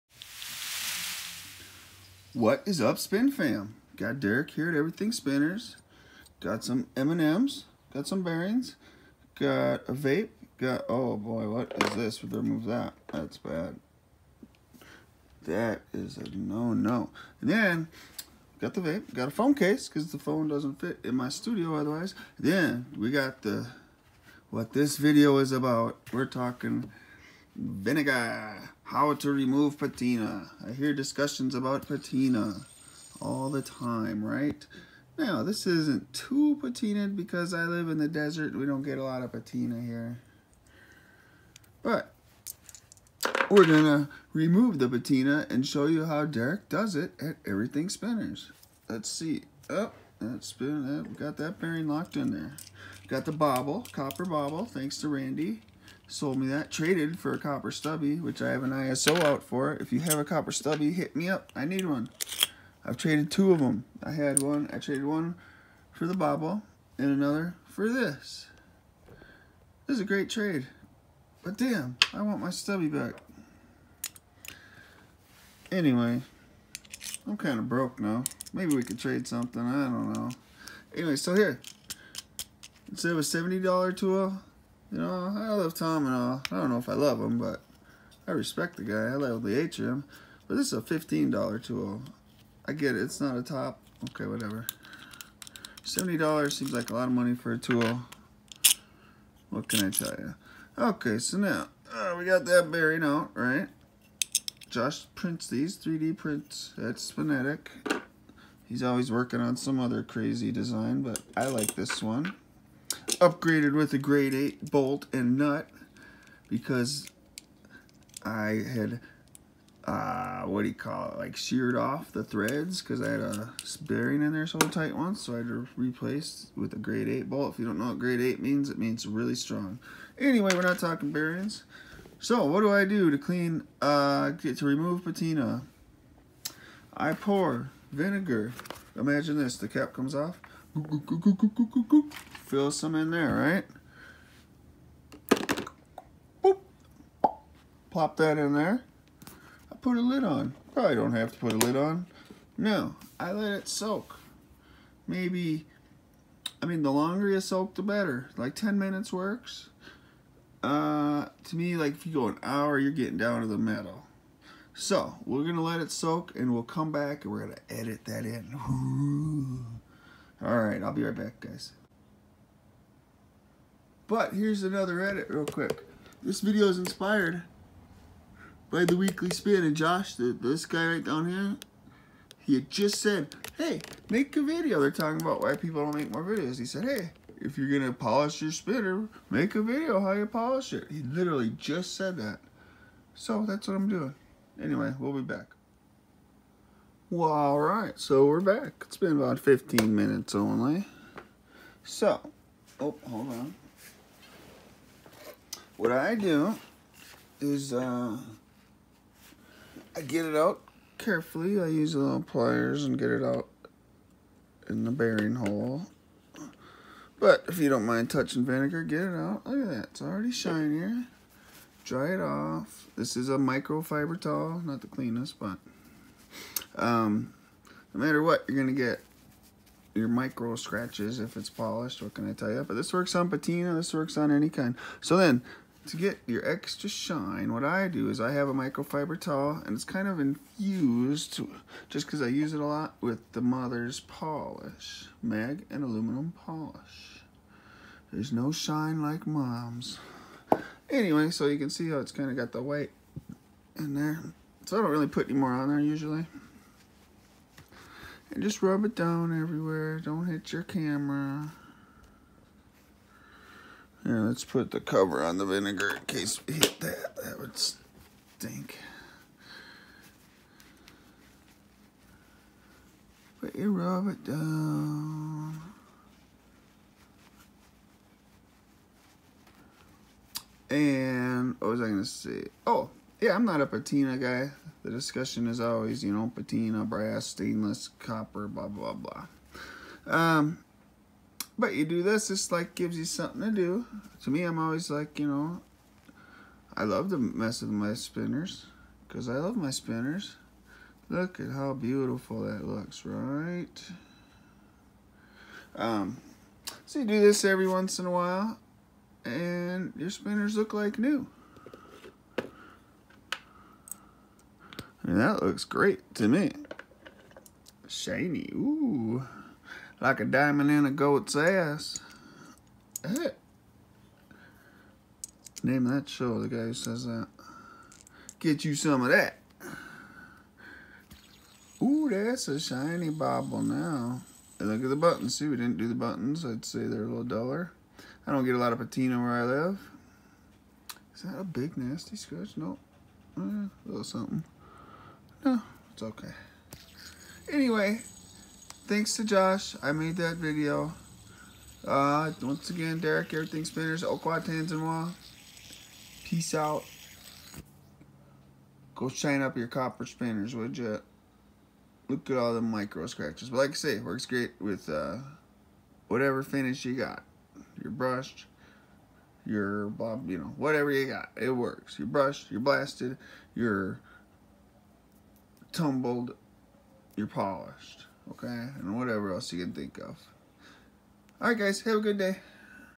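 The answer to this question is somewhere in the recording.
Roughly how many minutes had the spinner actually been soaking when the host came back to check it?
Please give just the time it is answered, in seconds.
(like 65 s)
199 s.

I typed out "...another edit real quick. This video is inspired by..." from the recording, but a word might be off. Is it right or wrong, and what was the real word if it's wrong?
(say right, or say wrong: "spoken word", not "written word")
right.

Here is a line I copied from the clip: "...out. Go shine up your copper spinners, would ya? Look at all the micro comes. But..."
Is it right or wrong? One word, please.
wrong.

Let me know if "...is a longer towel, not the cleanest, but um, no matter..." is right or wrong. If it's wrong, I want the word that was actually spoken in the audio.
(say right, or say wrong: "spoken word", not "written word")
wrong: "microfiber", not "longer".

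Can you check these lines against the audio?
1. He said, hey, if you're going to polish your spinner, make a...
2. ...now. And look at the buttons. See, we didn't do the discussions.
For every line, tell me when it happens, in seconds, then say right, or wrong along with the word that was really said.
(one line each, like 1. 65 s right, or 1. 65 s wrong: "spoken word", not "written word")
1. 186 s right
2. 333 s wrong: "buttons", not "discussions".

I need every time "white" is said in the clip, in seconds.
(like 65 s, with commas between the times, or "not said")
252 s.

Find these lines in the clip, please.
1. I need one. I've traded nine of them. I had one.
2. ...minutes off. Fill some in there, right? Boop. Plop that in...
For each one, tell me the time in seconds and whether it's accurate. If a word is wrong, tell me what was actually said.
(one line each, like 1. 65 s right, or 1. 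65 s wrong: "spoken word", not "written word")
1. 61 s wrong: "two", not "nine"
2. 139 s wrong: "comes", not "minutes".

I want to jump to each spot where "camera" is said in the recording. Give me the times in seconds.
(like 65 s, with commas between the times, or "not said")
260 s.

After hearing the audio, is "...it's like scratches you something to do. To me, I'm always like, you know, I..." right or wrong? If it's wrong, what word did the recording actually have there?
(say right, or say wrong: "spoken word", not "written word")
wrong: "gives", not "scratches".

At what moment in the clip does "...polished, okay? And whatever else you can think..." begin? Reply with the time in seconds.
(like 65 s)
377 s.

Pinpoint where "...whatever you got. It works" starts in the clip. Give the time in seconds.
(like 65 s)
370 s.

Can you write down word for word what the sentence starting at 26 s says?
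We're talking vinegar, how to remove patina.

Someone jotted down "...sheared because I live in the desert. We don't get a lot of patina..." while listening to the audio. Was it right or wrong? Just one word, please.
wrong.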